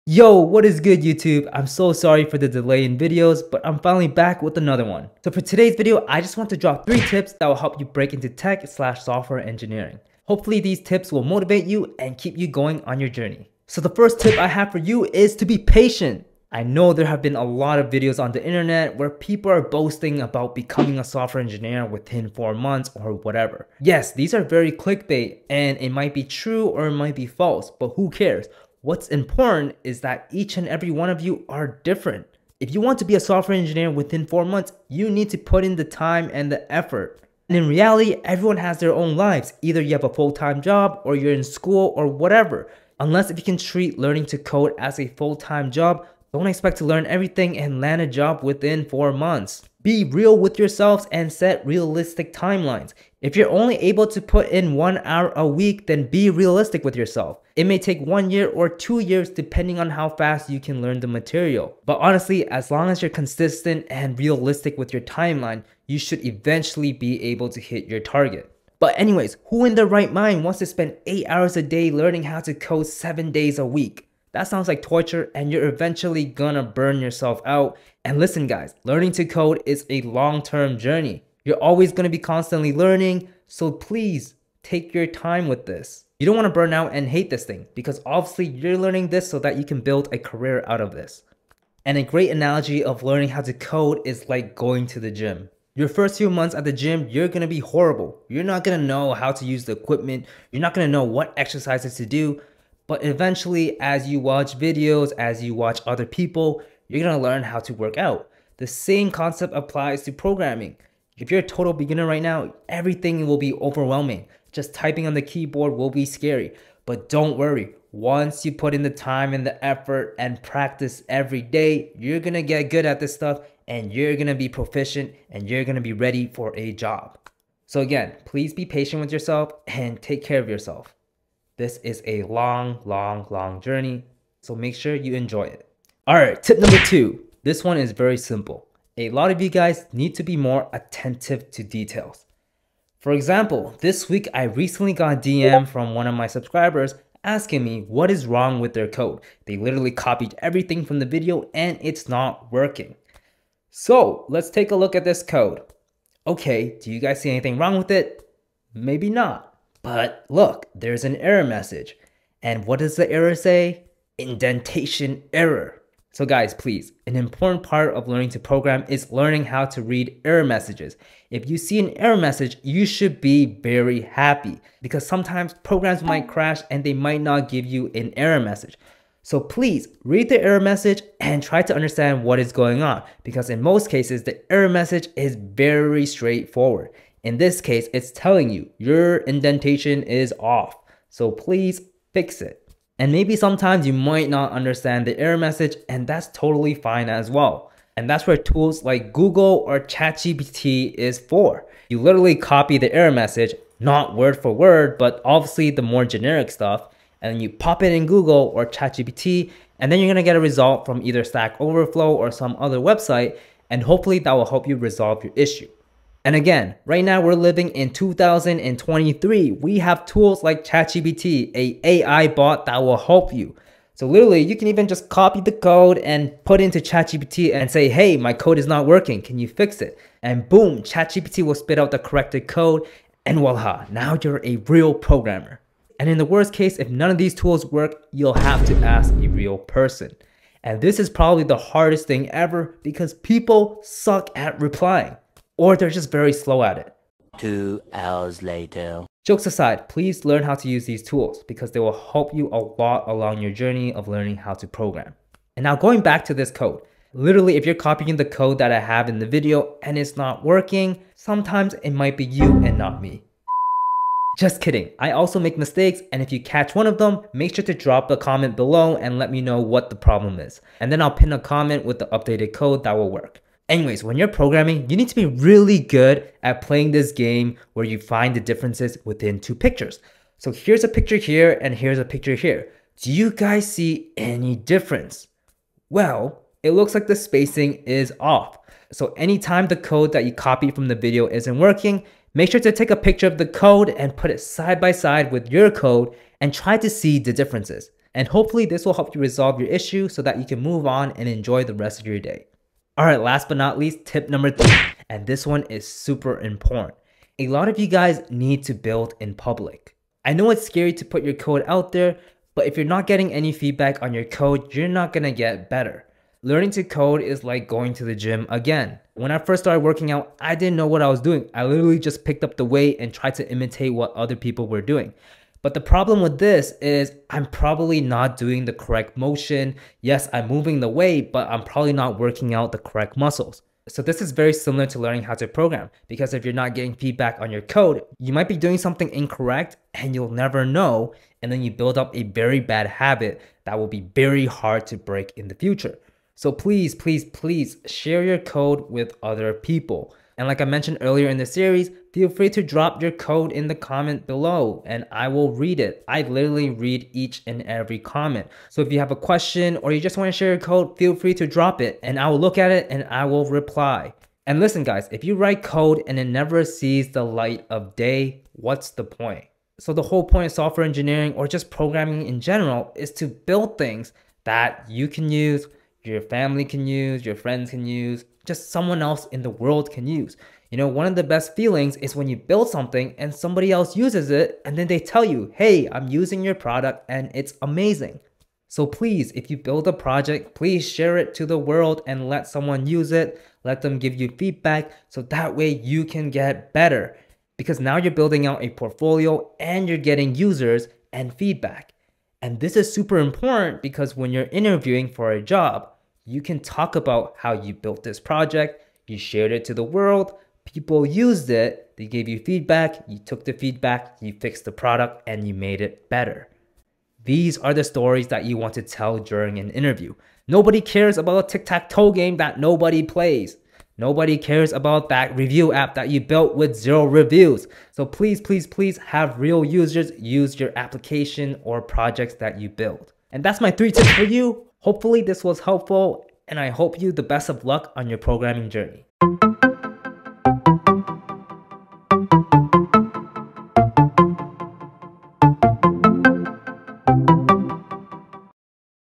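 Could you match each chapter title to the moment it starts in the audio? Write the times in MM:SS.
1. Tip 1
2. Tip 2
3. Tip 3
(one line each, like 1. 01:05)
1. 00:14
2. 02:16
3. 05:04.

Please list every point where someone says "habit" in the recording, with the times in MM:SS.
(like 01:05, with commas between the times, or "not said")
05:42.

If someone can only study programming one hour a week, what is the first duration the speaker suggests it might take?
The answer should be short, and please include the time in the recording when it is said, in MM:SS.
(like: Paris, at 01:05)
1 year, at 00:58.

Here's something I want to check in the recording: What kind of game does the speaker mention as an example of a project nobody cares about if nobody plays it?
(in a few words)
Tic-tac-toe.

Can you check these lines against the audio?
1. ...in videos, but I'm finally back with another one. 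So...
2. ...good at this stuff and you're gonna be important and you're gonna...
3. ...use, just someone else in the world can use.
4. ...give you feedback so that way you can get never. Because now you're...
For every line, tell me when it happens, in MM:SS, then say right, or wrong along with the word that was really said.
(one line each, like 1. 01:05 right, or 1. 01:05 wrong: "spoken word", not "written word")
1. 00:02 right
2. 02:02 wrong: "proficient", not "important"
3. 06:17 right
4. 06:33 wrong: "better", not "never".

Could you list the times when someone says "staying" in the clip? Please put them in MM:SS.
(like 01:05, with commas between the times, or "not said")
not said.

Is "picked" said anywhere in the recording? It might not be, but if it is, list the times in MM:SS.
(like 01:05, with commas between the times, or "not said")
05:22.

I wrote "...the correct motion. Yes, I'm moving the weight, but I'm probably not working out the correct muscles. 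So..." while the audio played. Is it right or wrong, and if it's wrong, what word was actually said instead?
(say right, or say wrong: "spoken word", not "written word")
right.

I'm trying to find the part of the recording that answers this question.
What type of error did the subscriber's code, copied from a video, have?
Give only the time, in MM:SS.
02:44.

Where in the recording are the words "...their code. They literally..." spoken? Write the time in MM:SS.
02:28.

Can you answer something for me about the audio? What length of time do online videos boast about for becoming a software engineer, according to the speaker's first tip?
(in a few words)
4 months.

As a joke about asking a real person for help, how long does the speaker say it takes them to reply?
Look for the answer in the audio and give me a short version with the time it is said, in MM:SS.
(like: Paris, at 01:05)
2 hours, at 04:07.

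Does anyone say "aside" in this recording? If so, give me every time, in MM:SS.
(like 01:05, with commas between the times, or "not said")
04:09.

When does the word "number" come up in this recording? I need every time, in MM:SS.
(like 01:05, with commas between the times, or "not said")
02:16, 05:04.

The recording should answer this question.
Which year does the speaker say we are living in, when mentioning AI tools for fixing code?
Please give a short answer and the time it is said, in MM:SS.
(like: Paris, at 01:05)
2023, at 03:37.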